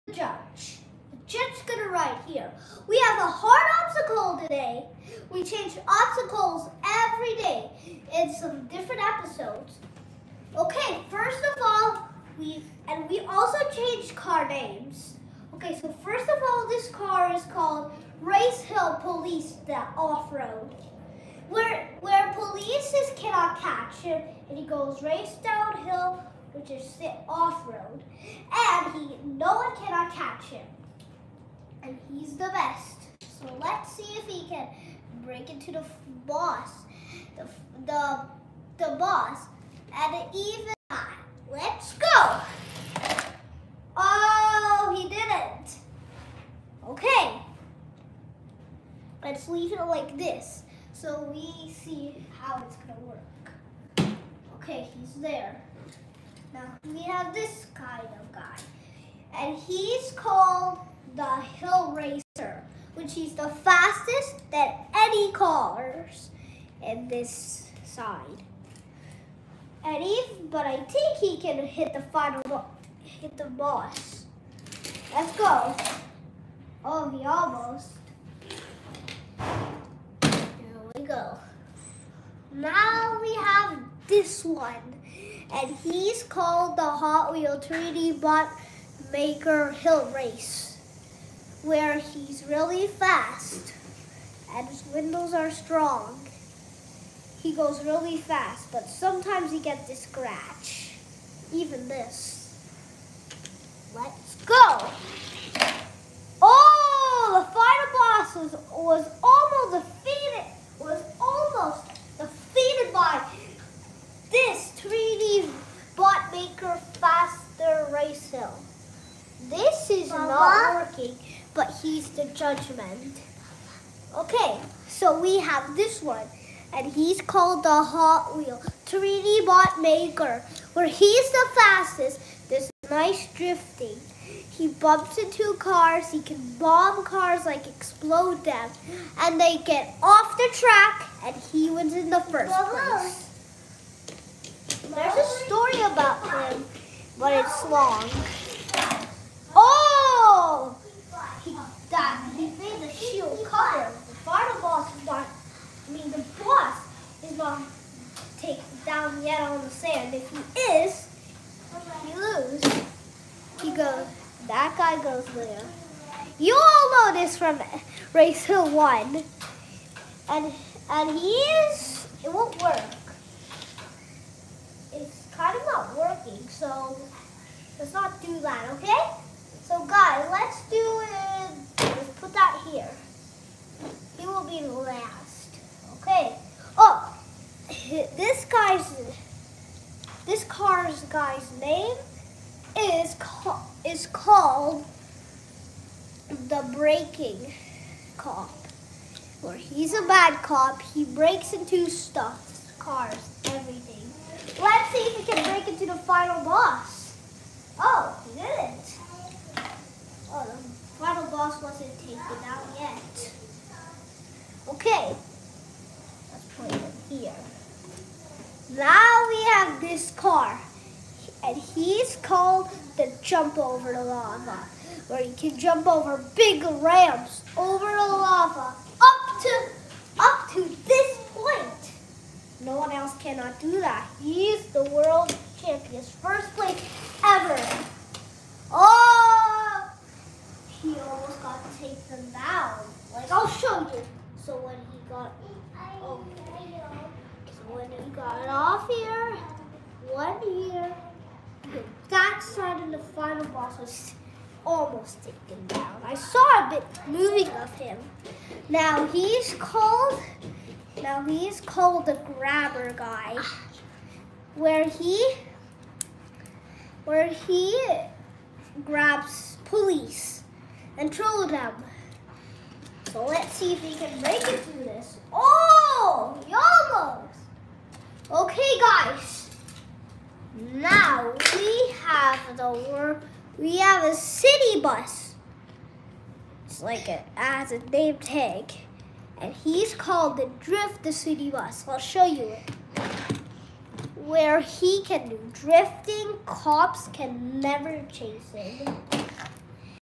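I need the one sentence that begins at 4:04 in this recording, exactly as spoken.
So when he got got off here, one here.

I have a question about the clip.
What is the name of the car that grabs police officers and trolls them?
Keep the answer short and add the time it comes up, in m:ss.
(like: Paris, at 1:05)
Grabber Guy, at 4:22.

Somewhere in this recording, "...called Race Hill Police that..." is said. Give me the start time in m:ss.
0:17.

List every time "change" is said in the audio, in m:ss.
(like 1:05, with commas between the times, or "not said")
0:05, 0:13.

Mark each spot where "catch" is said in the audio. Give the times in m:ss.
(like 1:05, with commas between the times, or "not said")
0:23.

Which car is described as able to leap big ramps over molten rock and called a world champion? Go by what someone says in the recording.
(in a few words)
Jump Over the Lava.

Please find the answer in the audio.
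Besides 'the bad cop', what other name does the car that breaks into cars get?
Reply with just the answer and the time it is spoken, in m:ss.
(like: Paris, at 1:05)
Breaking Cop, at 3:16.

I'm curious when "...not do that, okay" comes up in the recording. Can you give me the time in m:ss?
2:57.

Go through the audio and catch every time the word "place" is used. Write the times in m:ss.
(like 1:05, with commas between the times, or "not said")
2:22, 3:56.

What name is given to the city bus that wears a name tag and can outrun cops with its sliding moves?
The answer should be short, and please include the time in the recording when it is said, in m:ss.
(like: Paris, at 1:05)
Drift the City Bus, at 4:50.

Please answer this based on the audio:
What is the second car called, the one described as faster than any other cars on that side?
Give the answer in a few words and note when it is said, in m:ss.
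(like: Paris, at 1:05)
Hill Racer, at 1:01.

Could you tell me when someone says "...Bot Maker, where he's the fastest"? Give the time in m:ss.
2:09.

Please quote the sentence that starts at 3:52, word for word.
No one else cannot do that.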